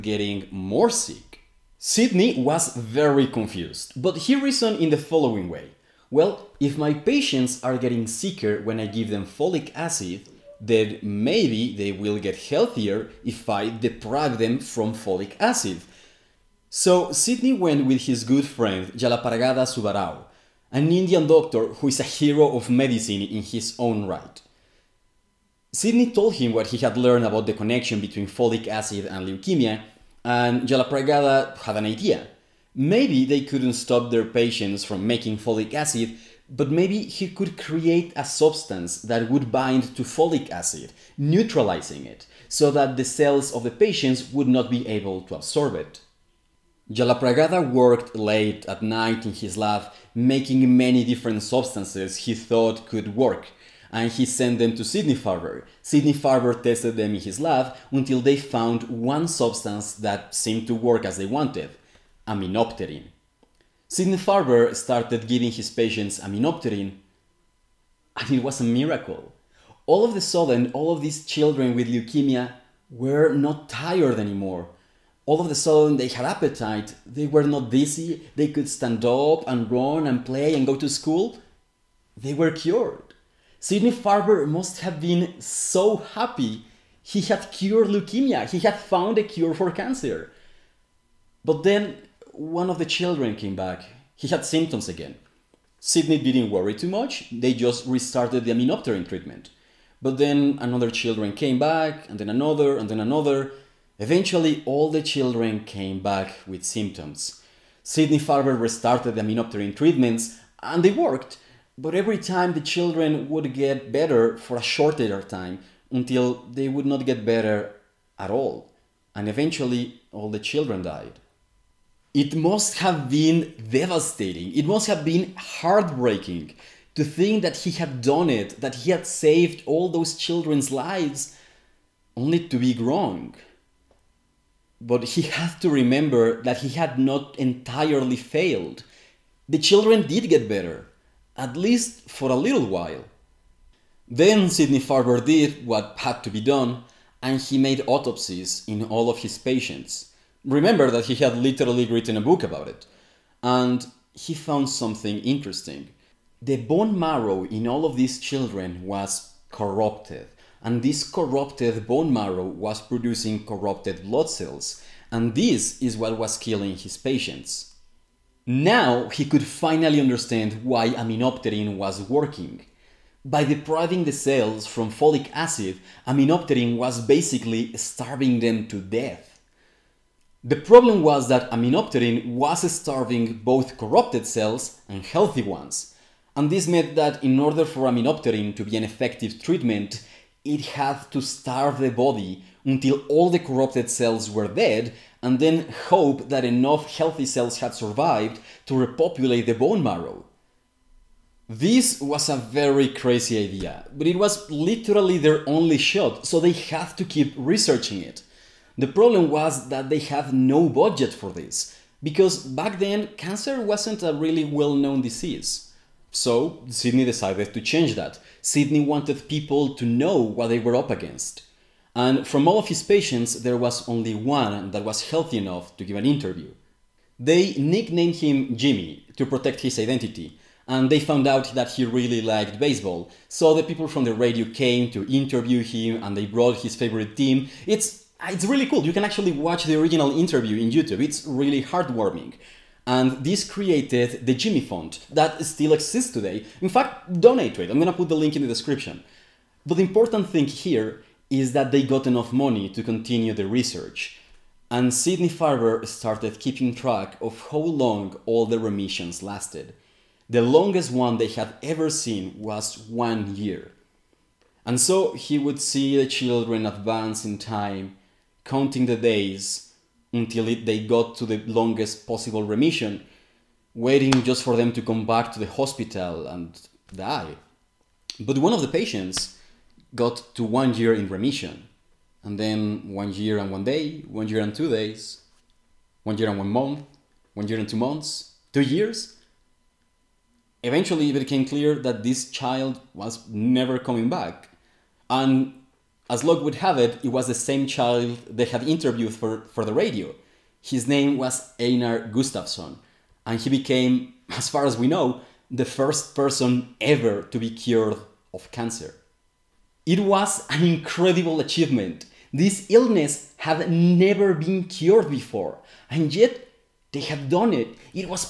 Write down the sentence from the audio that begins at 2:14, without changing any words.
But he had to remember that he had not entirely failed.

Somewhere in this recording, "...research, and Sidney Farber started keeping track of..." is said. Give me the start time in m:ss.
4:13.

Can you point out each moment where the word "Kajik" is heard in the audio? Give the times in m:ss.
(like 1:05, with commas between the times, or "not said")
not said.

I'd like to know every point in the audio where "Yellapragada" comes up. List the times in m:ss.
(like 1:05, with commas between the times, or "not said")
0:18, 0:30, 0:46.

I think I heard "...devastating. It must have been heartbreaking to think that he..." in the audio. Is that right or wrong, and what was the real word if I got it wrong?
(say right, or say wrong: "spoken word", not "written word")
right.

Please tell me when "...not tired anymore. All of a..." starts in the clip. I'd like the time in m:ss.
1:13.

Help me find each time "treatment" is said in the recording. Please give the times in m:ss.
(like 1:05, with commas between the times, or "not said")
1:39, 1:49, 3:09.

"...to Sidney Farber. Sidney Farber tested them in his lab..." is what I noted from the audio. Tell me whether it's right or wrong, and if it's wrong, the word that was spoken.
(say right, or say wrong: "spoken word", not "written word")
right.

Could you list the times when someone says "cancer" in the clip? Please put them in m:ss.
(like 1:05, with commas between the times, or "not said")
1:29, 3:33, 5:08.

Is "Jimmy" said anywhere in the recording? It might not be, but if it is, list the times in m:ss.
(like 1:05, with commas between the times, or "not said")
3:48, 4:04.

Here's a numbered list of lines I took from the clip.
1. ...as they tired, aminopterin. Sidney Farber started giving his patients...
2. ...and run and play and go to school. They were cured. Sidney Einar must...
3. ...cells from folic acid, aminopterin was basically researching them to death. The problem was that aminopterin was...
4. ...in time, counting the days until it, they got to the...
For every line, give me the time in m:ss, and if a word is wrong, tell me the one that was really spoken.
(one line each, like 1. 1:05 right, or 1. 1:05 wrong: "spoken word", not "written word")
1. 1:01 wrong: "wanted", not "tired"
2. 1:19 wrong: "Farber", not "Einar"
3. 2:54 wrong: "starving", not "researching"
4. 4:27 right.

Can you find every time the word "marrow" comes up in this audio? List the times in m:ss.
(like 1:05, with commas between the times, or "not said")
2:36, 2:42, 3:19.